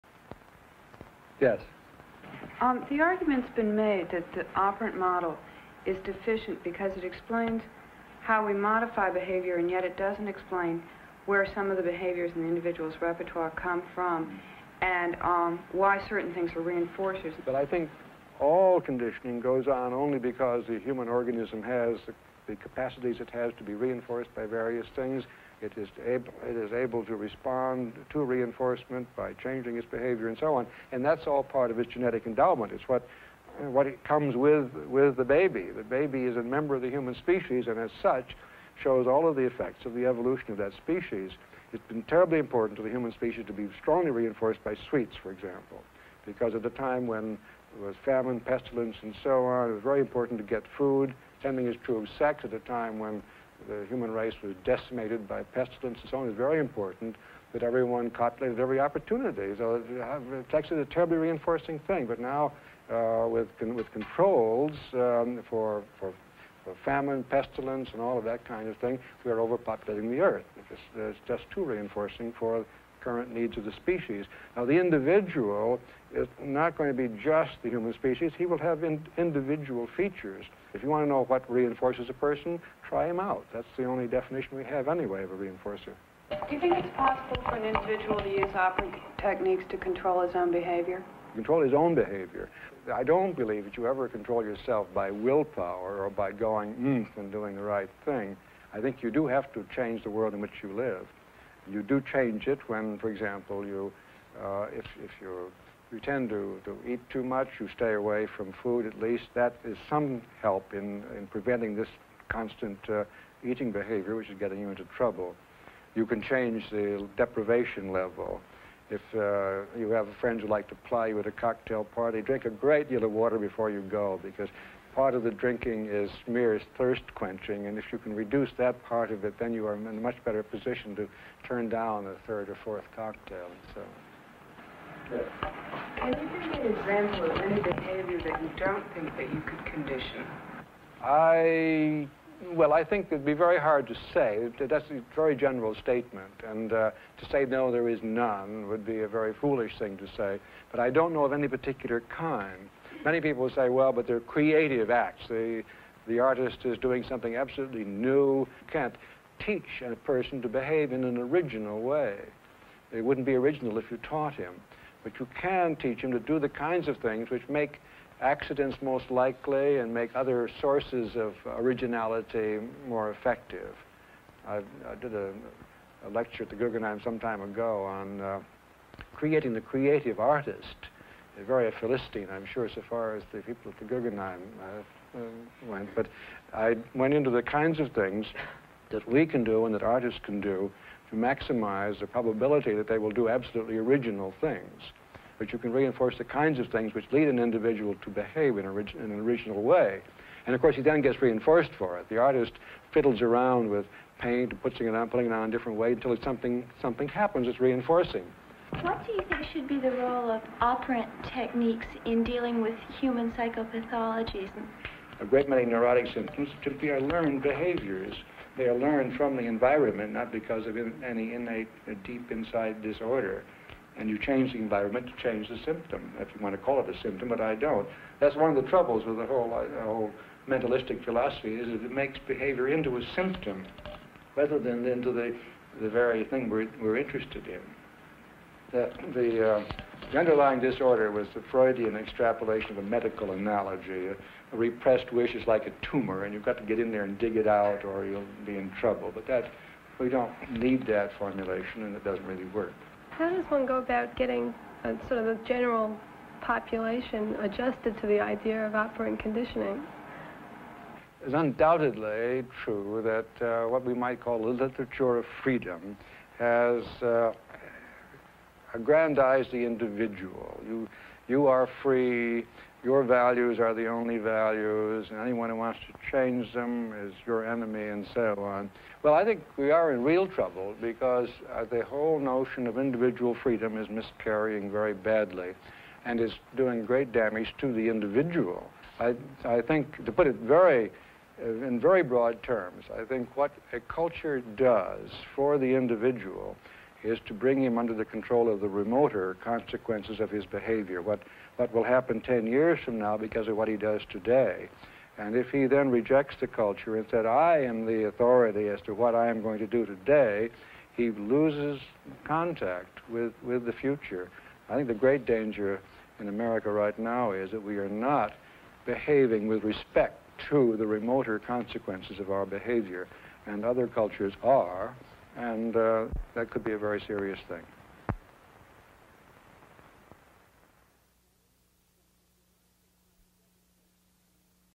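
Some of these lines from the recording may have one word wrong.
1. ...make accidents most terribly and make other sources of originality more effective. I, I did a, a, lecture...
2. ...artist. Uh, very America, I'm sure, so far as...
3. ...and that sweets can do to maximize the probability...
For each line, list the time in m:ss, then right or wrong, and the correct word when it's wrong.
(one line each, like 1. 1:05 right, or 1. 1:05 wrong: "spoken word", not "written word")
1. 2:47 wrong: "likely", not "terribly"
2. 3:00 wrong: "Philistine", not "America"
3. 3:09 wrong: "artists", not "sweets".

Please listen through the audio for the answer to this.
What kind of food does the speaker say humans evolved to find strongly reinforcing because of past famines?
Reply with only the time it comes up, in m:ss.
0:44.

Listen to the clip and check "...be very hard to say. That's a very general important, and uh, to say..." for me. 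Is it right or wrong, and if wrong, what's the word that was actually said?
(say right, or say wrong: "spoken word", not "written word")
wrong: "statement", not "important".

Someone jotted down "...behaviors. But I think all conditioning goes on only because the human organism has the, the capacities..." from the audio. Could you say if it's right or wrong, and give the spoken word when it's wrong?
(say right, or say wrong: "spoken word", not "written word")
wrong: "reinforcers", not "behaviors".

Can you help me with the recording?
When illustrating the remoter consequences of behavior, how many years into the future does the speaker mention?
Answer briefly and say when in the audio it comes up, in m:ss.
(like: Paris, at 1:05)
10, at 5:02.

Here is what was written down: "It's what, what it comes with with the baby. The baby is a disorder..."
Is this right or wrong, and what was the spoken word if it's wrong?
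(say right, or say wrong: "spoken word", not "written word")
wrong: "member", not "disorder".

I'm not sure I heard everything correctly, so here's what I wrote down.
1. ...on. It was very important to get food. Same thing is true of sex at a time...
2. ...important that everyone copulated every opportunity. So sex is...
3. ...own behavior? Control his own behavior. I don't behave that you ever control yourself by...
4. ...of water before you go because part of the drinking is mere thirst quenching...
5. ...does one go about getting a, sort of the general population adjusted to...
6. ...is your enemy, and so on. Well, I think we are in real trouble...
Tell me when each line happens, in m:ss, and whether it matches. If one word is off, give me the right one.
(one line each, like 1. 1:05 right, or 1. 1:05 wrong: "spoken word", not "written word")
1. 0:49 right
2. 0:56 right
3. 1:30 wrong: "believe", not "behave"
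4. 2:03 right
5. 4:13 right
6. 4:37 right.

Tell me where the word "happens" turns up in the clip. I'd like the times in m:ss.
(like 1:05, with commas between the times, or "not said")
3:27, 5:01.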